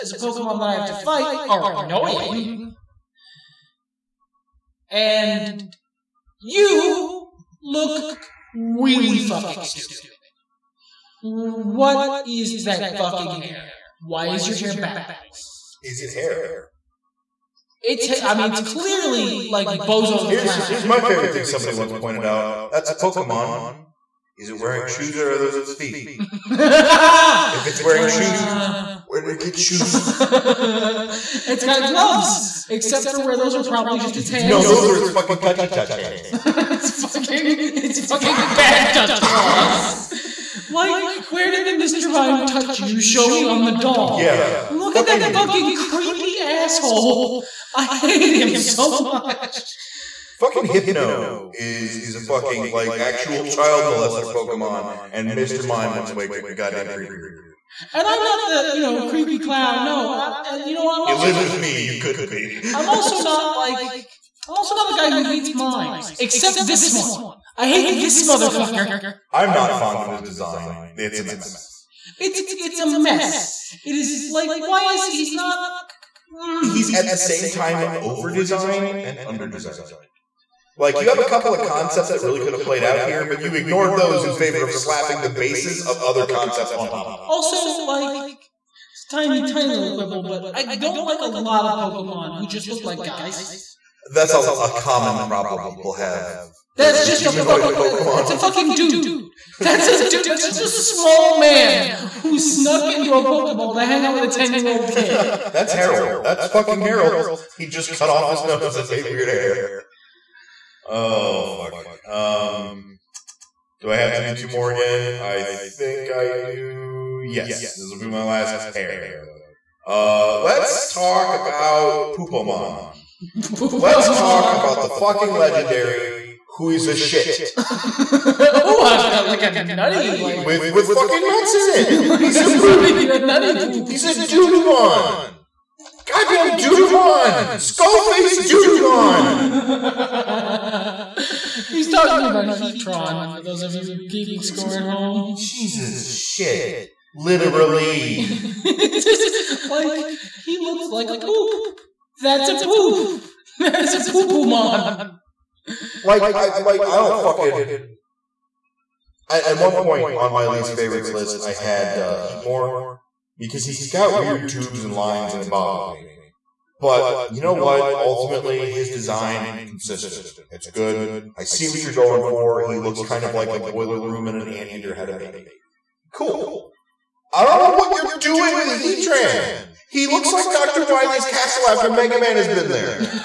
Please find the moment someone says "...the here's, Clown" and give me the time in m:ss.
0:20.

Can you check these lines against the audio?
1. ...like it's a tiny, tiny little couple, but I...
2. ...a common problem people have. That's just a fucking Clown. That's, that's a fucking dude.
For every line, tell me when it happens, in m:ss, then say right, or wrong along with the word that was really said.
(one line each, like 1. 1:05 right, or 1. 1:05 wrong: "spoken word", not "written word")
1. 1:27 wrong: "quibble", not "couple"
2. 1:34 wrong: "Pokemon", not "Clown".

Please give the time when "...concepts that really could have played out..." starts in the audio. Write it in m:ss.
1:21.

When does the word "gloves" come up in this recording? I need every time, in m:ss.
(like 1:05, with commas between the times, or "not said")
0:31.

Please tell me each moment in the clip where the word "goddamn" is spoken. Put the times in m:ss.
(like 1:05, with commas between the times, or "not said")
0:56, 2:16.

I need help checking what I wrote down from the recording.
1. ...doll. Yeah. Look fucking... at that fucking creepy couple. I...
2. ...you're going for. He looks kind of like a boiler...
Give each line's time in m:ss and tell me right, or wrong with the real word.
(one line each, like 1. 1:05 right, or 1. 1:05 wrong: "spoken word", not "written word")
1. 0:43 wrong: "asshole", not "couple"
2. 2:51 right.